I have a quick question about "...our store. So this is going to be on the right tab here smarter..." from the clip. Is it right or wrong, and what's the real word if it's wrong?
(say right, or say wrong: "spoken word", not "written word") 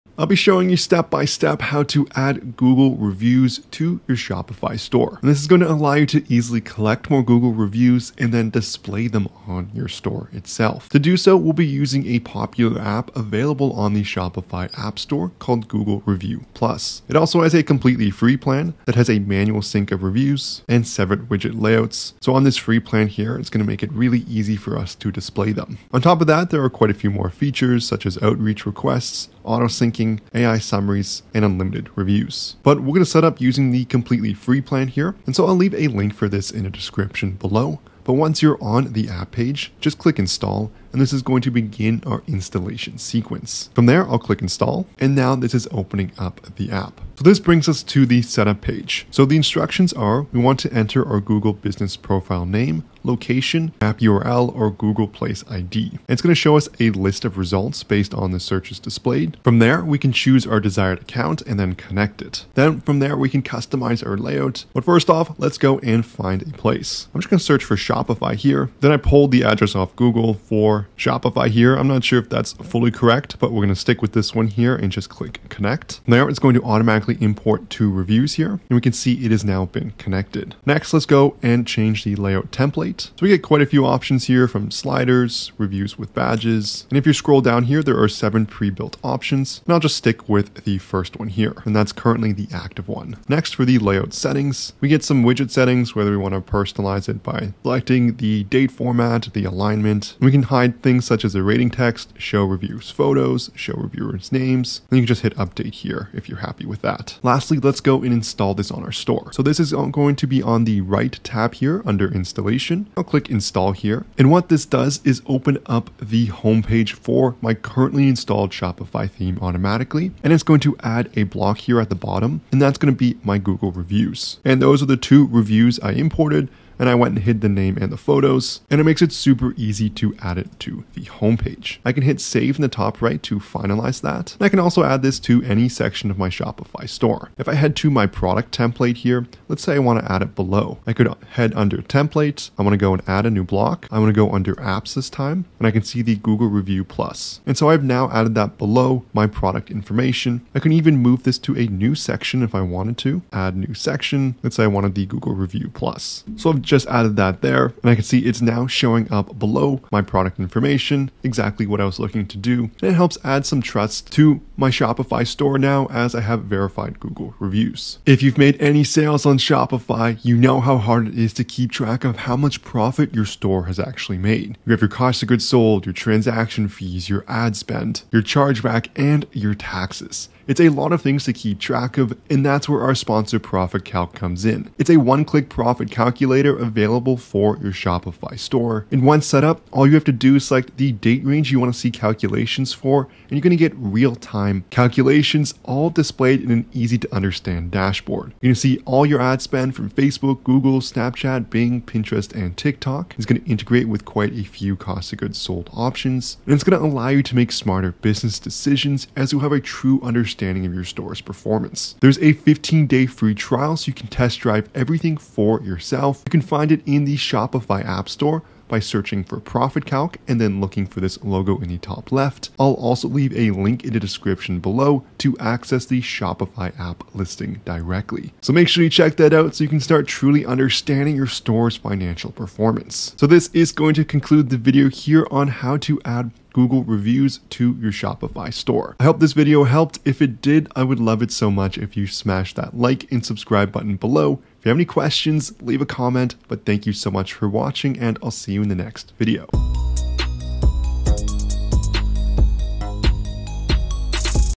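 wrong: "under", not "smarter".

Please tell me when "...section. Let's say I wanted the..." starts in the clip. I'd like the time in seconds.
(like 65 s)
153 s.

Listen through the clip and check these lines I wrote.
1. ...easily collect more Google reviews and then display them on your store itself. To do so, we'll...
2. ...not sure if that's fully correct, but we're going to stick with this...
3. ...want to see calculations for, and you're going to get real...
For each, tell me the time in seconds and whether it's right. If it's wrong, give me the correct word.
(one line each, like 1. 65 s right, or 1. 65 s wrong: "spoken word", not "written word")
1. 6 s right
2. 71 s right
3. 191 s right.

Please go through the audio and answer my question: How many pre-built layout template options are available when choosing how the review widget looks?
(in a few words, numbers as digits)
7.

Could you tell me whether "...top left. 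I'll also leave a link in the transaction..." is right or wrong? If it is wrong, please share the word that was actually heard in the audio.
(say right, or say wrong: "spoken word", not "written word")
wrong: "description", not "transaction".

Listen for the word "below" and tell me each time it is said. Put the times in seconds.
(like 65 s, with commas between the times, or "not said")
37 s, 140 s, 148 s, 159 s, 224 s, 243 s.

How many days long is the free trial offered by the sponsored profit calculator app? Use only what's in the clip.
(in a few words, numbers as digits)
15.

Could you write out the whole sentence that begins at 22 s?
So on this free plan here, it's going to make it really easy for us to display them.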